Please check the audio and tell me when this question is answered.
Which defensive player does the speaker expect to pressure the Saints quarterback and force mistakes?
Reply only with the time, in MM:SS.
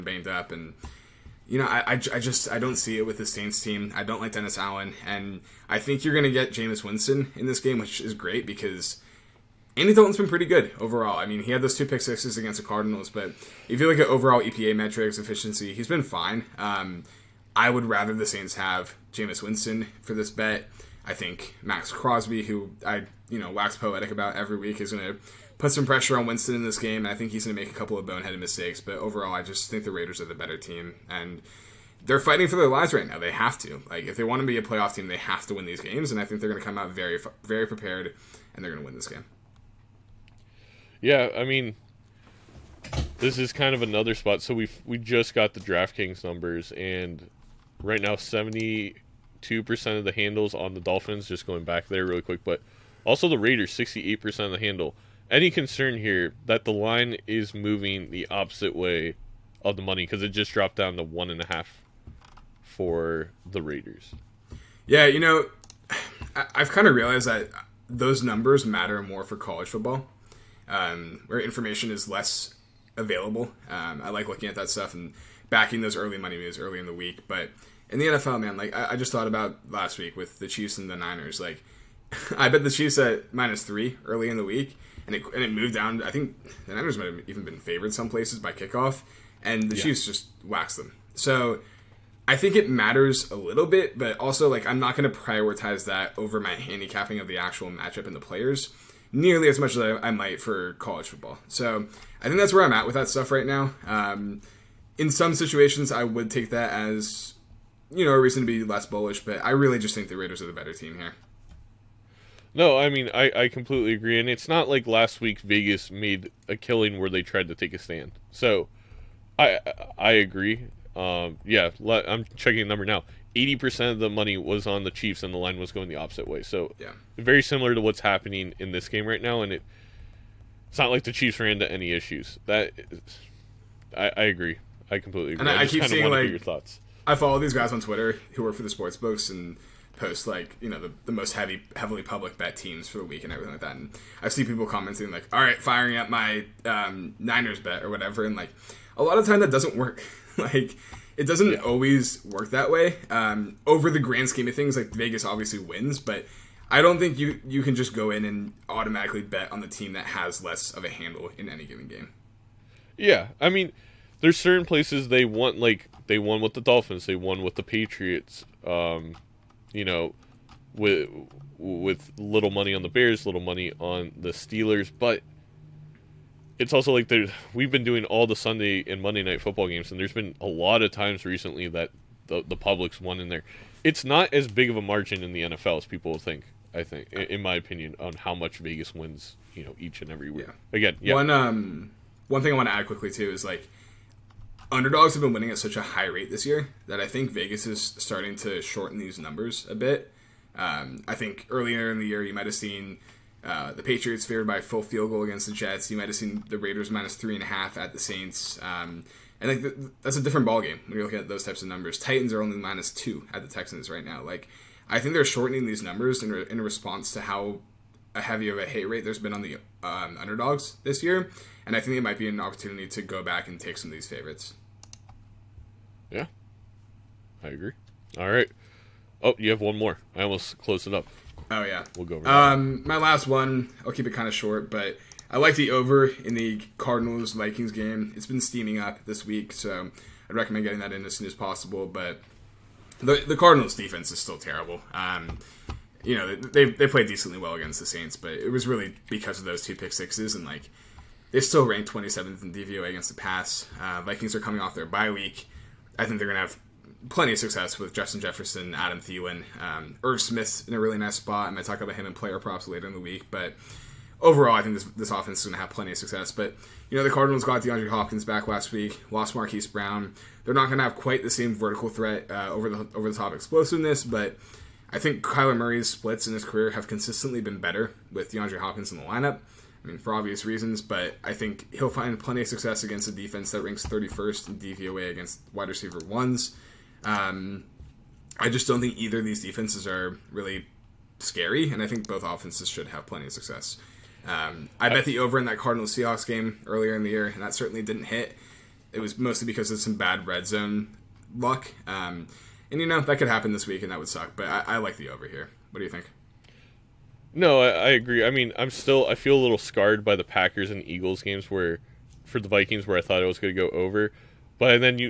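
00:21.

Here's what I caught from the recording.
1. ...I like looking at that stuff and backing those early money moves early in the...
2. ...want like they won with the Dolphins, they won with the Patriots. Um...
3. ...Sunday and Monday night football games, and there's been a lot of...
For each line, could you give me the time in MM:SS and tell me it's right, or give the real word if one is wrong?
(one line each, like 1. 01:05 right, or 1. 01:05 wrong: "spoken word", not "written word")
1. 01:14 right
2. 02:45 right
3. 02:58 right.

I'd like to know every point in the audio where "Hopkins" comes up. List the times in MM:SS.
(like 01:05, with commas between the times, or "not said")
04:27, 04:38.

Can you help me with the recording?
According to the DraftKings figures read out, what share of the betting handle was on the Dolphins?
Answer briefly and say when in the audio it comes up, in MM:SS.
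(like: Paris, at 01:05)
72%, at 00:48.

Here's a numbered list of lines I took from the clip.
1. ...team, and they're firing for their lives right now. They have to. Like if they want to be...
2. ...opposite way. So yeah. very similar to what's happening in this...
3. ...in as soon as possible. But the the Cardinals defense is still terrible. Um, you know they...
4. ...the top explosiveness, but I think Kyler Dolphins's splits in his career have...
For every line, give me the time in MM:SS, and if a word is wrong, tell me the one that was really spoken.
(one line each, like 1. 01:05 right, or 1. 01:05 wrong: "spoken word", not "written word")
1. 00:30 wrong: "fighting", not "firing"
2. 02:05 right
3. 04:00 right
4. 04:33 wrong: "Murray", not "Dolphins".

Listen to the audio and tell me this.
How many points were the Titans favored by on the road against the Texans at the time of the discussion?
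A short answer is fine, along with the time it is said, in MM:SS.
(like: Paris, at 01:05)
2, at 03:32.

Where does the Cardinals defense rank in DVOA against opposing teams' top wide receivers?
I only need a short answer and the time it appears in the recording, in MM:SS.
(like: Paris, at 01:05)
31st, at 04:43.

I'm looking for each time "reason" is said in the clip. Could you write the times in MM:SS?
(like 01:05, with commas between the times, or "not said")
01:48, 04:40.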